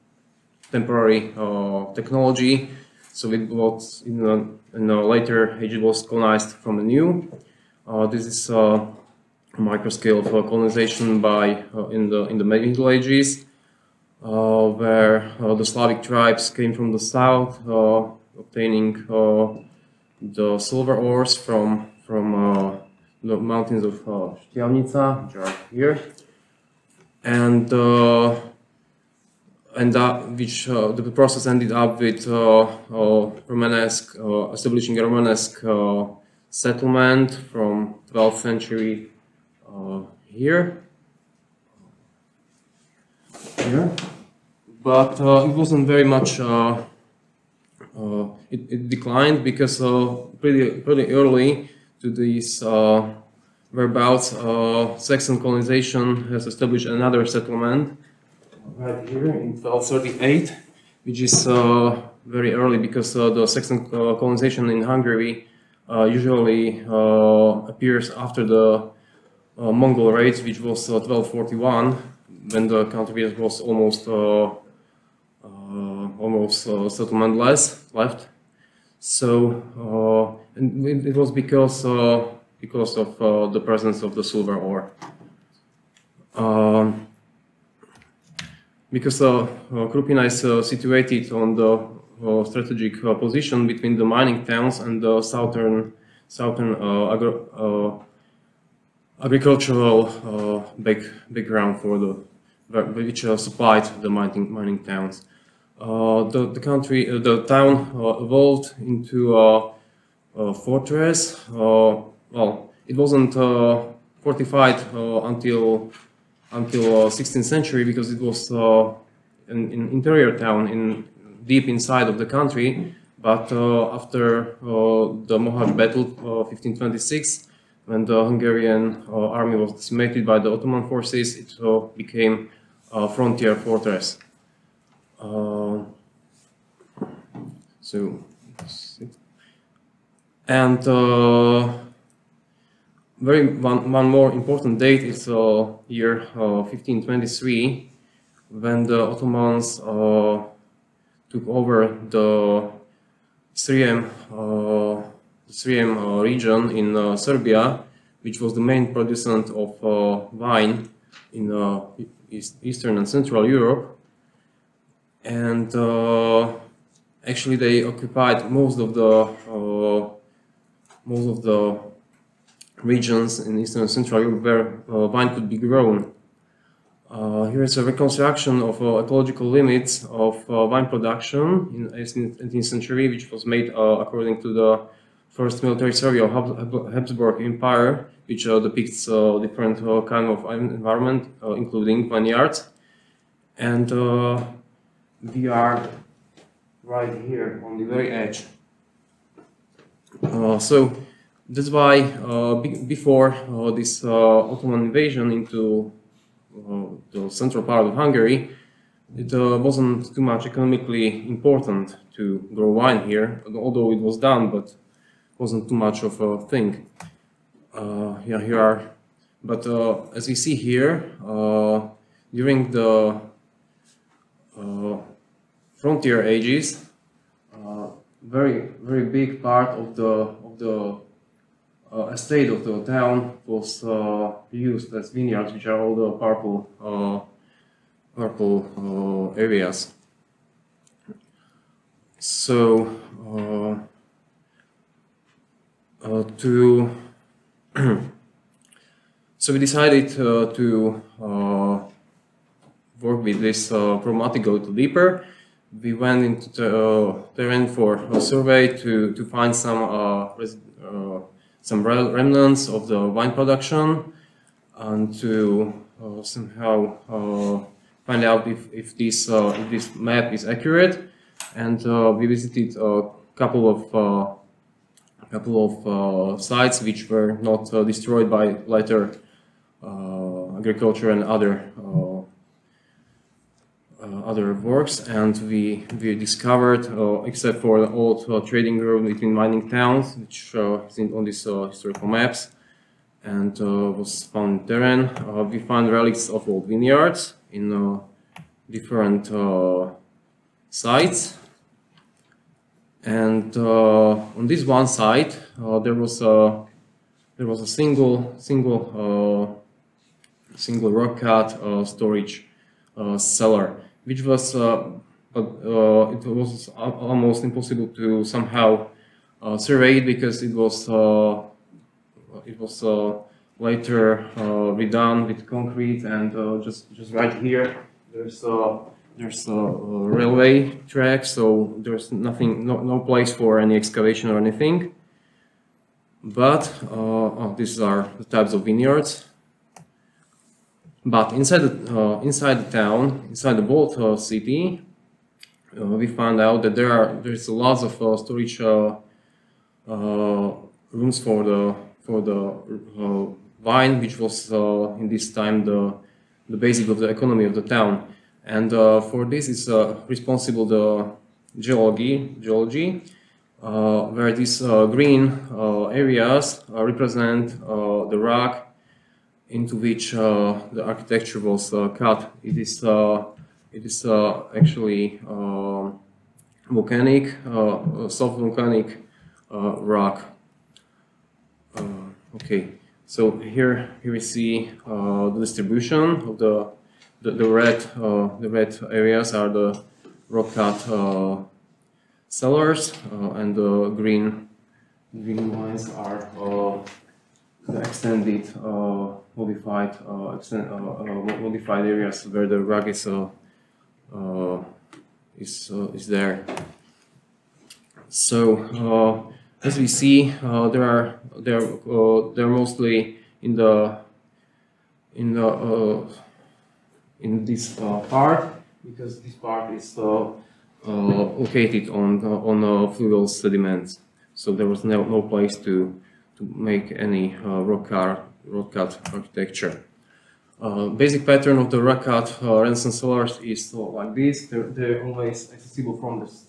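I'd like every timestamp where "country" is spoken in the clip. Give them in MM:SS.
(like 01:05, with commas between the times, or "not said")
01:12, 01:46, 02:02.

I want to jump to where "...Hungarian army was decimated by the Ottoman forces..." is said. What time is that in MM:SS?
02:08.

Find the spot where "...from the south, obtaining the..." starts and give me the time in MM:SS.
00:16.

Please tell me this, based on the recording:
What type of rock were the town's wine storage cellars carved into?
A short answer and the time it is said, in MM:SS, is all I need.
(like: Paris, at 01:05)
Soft volcanic rock, at 06:18.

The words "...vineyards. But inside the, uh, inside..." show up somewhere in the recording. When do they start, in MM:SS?
05:38.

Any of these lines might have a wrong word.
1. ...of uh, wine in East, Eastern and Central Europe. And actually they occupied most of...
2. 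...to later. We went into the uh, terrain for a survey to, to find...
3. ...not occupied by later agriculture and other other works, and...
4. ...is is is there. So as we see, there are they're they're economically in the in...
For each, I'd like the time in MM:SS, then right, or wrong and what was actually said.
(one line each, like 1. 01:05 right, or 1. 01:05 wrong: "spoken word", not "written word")
1. 02:39 right
2. 04:14 wrong: "deeper", not "later"
3. 04:37 wrong: "destroyed", not "occupied"
4. 06:42 wrong: "mostly", not "economically".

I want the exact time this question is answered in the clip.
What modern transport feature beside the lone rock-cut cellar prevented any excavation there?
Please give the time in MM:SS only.
05:29.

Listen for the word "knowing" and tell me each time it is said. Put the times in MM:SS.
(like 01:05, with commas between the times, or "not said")
not said.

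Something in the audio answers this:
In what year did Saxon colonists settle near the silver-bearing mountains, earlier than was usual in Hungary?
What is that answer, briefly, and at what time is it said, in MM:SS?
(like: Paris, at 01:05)
1238, at 00:59.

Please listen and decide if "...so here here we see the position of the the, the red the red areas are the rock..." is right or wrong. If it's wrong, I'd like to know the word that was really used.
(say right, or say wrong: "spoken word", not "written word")
wrong: "distribution", not "position".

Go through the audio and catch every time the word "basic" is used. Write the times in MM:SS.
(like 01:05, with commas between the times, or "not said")
05:56, 07:10.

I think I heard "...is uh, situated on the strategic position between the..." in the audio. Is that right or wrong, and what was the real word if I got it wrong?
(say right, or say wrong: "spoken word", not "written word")
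right.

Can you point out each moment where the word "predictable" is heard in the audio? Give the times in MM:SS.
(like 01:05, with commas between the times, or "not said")
not said.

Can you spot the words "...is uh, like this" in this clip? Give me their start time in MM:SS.
07:13.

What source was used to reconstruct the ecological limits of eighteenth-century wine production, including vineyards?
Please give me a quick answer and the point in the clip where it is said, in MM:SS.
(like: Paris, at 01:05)
First military survey, at 03:05.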